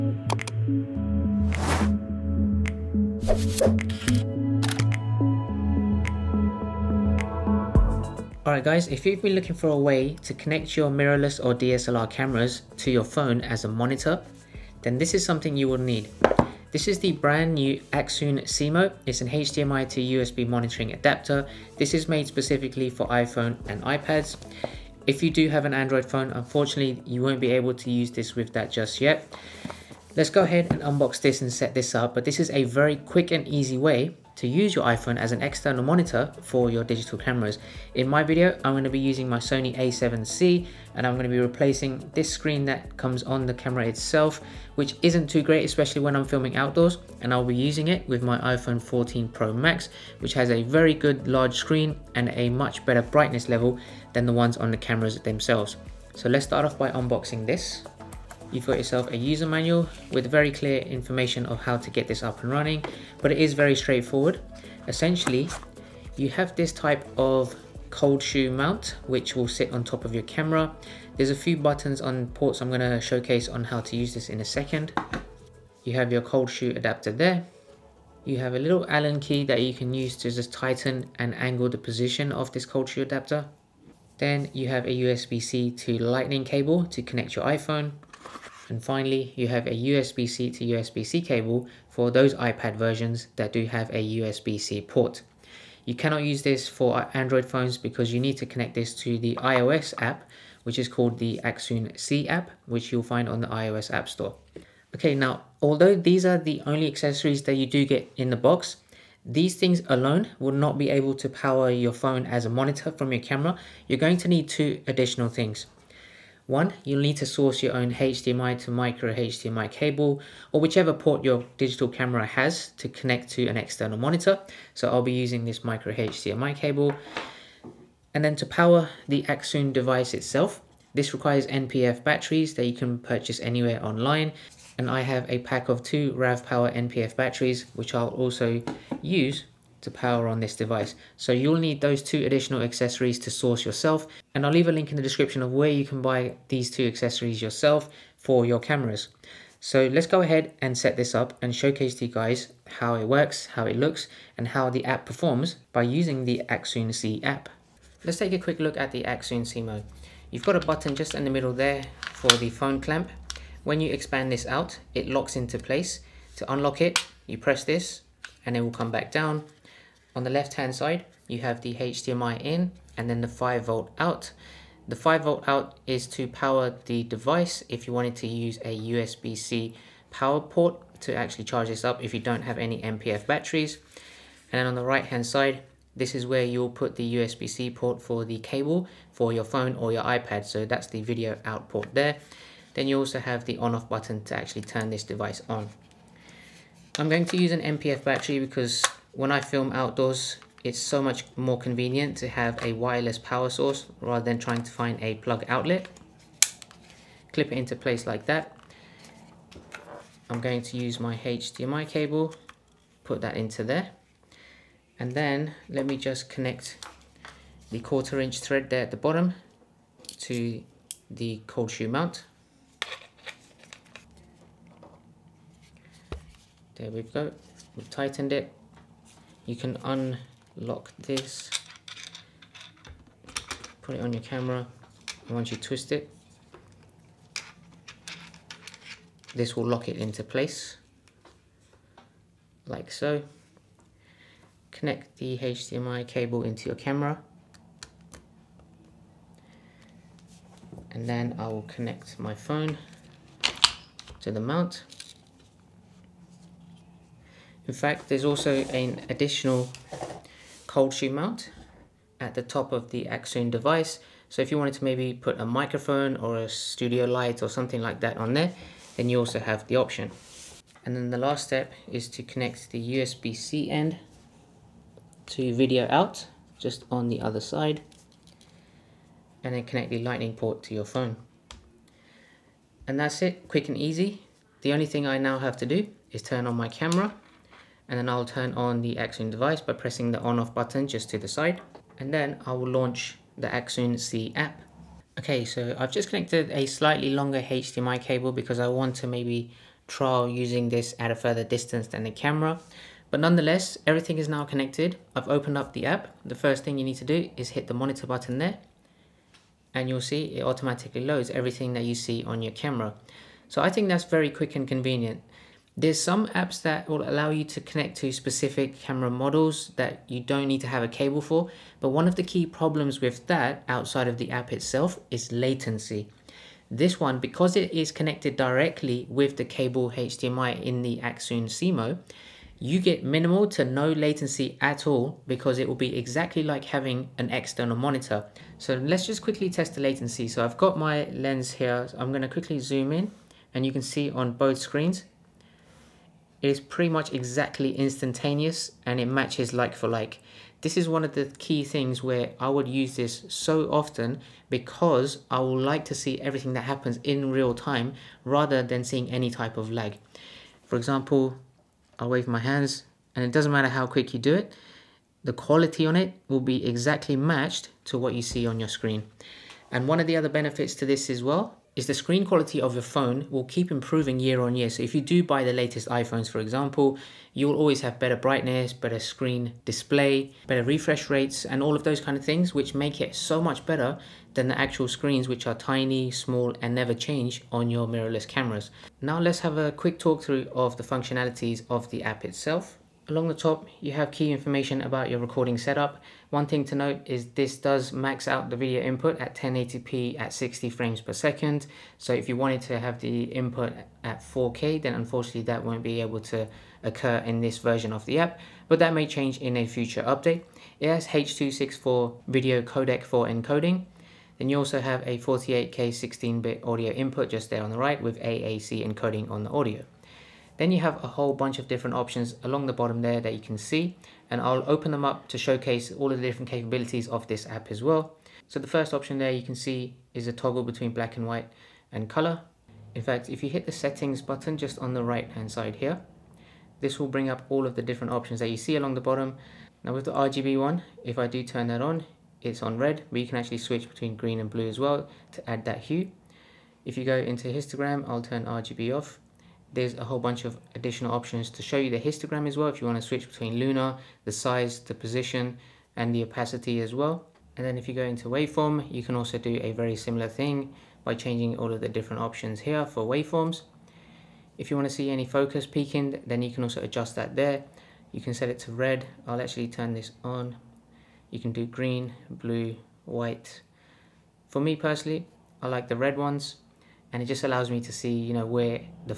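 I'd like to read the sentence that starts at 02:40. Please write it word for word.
You've got a button just in the middle there for the phone clamp.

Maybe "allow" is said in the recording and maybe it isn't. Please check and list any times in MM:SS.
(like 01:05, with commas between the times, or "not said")
05:17, 07:57.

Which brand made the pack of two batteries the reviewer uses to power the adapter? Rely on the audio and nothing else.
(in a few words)
RAV Power.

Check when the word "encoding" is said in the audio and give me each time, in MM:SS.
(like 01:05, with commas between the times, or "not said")
06:53, 06:58.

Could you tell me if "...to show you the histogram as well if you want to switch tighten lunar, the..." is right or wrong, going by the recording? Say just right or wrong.
wrong.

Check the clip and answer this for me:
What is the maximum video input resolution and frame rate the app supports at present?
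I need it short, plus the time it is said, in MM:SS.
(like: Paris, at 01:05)
1080p at 60 fps, at 06:39.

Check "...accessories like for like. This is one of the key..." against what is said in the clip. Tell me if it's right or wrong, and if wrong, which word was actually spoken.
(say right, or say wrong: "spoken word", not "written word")
wrong: "matches", not "accessories".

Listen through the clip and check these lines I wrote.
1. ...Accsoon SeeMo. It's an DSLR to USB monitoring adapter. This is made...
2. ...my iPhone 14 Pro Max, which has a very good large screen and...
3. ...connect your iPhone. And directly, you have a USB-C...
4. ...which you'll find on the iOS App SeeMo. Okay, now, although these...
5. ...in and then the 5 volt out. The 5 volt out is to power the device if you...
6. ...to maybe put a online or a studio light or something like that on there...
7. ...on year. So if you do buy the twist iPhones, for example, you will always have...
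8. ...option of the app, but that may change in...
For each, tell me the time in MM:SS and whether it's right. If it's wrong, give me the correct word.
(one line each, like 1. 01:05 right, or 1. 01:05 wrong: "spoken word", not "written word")
1. 00:17 wrong: "HDMI", not "DSLR"
2. 00:48 right
3. 01:27 wrong: "finally", not "directly"
4. 01:42 wrong: "Store", not "SeeMo"
5. 02:52 right
6. 04:24 wrong: "microphone", not "online"
7. 06:14 wrong: "latest", not "twist"
8. 06:47 wrong: "version", not "option".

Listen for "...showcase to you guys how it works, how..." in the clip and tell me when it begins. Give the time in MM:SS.
02:31.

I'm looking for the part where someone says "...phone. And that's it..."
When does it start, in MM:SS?
04:40.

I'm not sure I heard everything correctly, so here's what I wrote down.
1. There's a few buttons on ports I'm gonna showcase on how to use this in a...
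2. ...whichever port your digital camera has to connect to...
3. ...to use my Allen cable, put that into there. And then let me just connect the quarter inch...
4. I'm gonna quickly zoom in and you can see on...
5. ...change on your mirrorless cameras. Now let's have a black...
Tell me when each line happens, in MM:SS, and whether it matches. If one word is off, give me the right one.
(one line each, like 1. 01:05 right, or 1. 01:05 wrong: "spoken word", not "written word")
1. 01:11 right
2. 02:00 right
3. 03:30 wrong: "HDMI", not "Allen"
4. 05:41 right
5. 06:26 wrong: "quick", not "black".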